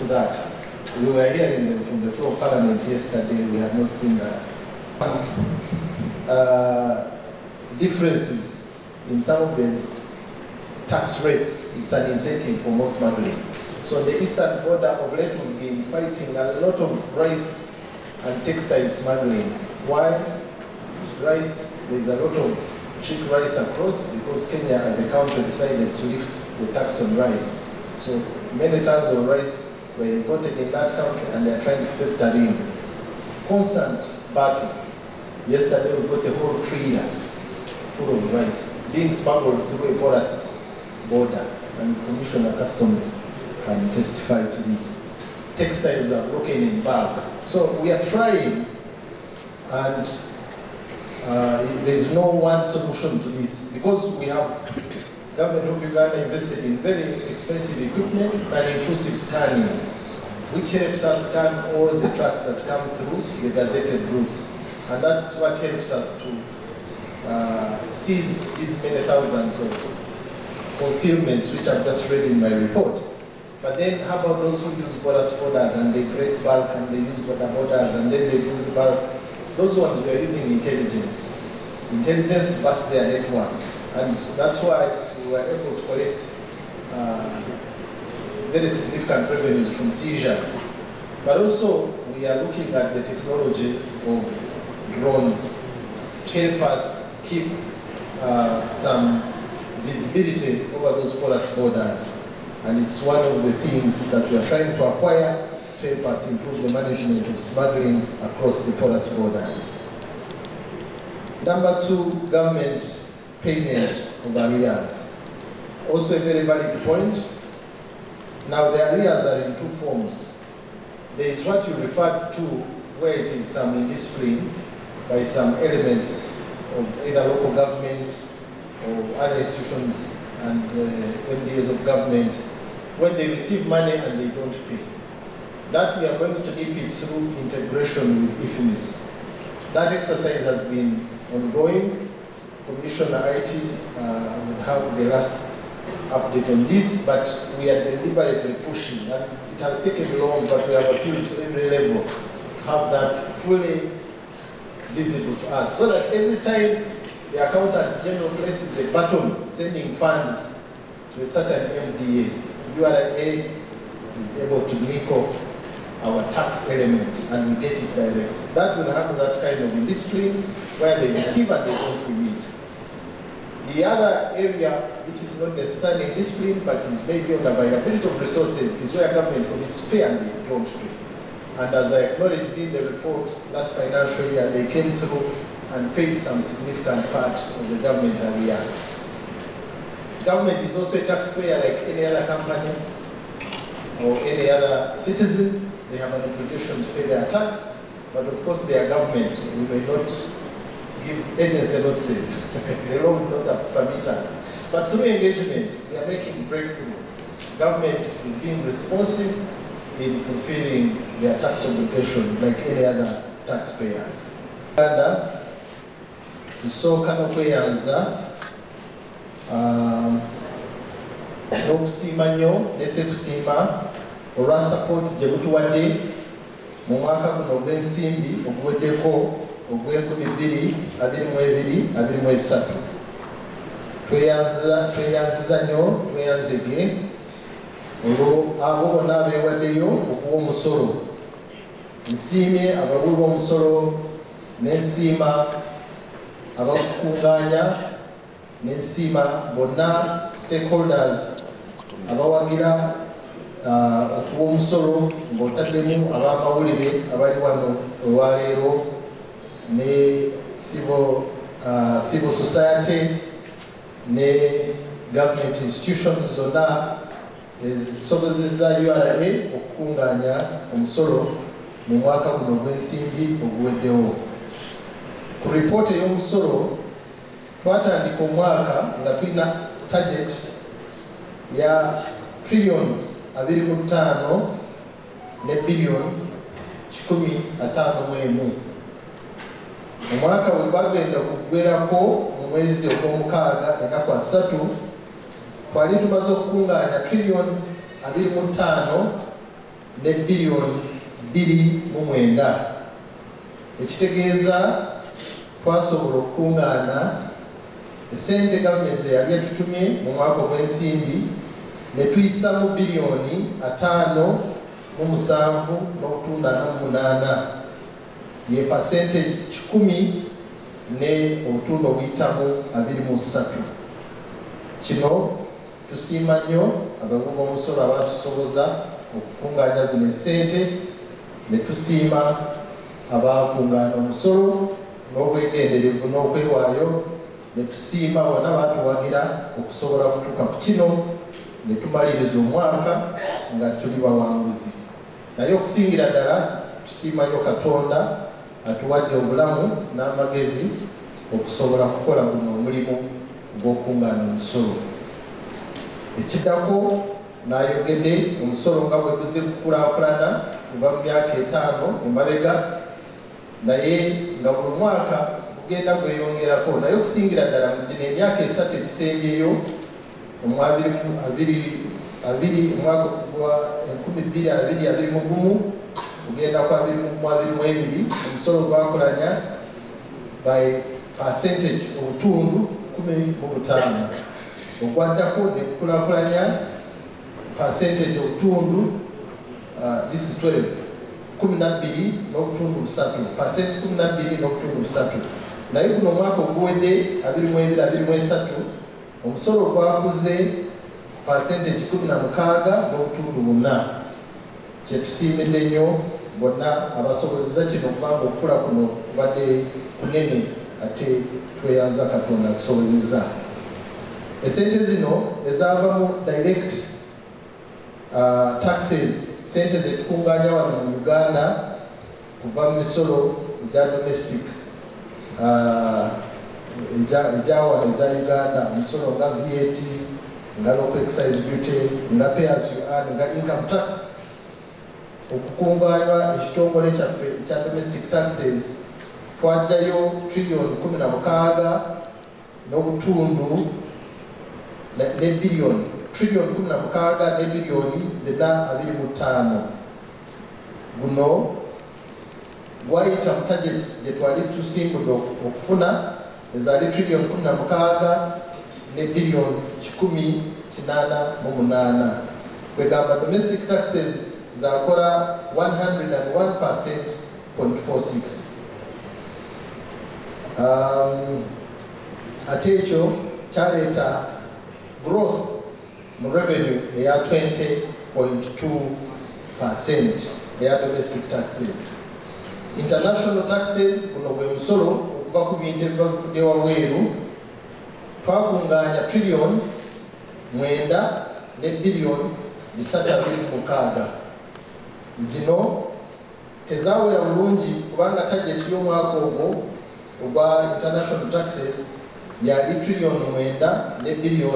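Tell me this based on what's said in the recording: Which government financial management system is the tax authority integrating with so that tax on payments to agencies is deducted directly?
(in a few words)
IFMIS.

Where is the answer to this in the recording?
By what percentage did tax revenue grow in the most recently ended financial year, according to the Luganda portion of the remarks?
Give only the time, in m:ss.
6:41.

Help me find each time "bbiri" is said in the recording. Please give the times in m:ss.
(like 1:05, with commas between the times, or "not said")
3:50, 5:01.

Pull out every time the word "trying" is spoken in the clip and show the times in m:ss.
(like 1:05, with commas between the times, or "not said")
0:31, 0:48, 1:44.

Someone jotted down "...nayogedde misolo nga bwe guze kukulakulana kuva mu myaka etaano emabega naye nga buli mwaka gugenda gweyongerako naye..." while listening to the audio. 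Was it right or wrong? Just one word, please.
wrong.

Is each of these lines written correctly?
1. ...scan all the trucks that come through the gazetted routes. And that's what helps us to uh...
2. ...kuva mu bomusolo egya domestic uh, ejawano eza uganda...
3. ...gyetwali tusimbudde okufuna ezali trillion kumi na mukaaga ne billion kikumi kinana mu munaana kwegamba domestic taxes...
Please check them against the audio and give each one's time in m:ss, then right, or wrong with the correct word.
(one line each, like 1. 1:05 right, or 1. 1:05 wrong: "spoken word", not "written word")
1. 1:01 right
2. 7:02 wrong: "misolo", not "bomusolo"
3. 7:34 right.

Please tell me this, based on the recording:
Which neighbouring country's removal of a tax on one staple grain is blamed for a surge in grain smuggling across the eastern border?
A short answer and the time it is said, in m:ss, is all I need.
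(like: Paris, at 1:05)
Kenya, at 0:24.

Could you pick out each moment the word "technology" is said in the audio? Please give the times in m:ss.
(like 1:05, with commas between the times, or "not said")
1:33.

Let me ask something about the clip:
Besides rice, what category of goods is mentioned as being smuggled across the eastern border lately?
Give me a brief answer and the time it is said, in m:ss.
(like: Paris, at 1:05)
textiles, at 0:18.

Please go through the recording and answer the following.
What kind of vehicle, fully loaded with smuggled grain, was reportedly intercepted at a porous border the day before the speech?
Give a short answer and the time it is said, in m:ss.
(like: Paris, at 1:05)
trailer, at 0:36.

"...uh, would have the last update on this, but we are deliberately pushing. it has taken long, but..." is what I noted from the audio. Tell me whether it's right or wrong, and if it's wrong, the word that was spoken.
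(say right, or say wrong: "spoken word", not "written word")
right.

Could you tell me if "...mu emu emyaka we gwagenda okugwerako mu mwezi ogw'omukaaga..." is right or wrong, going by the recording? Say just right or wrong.
wrong.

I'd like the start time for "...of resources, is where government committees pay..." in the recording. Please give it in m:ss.
2:58.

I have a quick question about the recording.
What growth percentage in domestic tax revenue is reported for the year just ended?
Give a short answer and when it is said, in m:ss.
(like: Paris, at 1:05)
20.2, at 7:57.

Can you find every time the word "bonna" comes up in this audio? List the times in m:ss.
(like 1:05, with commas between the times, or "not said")
3:58, 4:09, 6:46.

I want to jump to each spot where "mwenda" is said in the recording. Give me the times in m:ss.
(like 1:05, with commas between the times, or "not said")
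5:02, 8:10, 8:23.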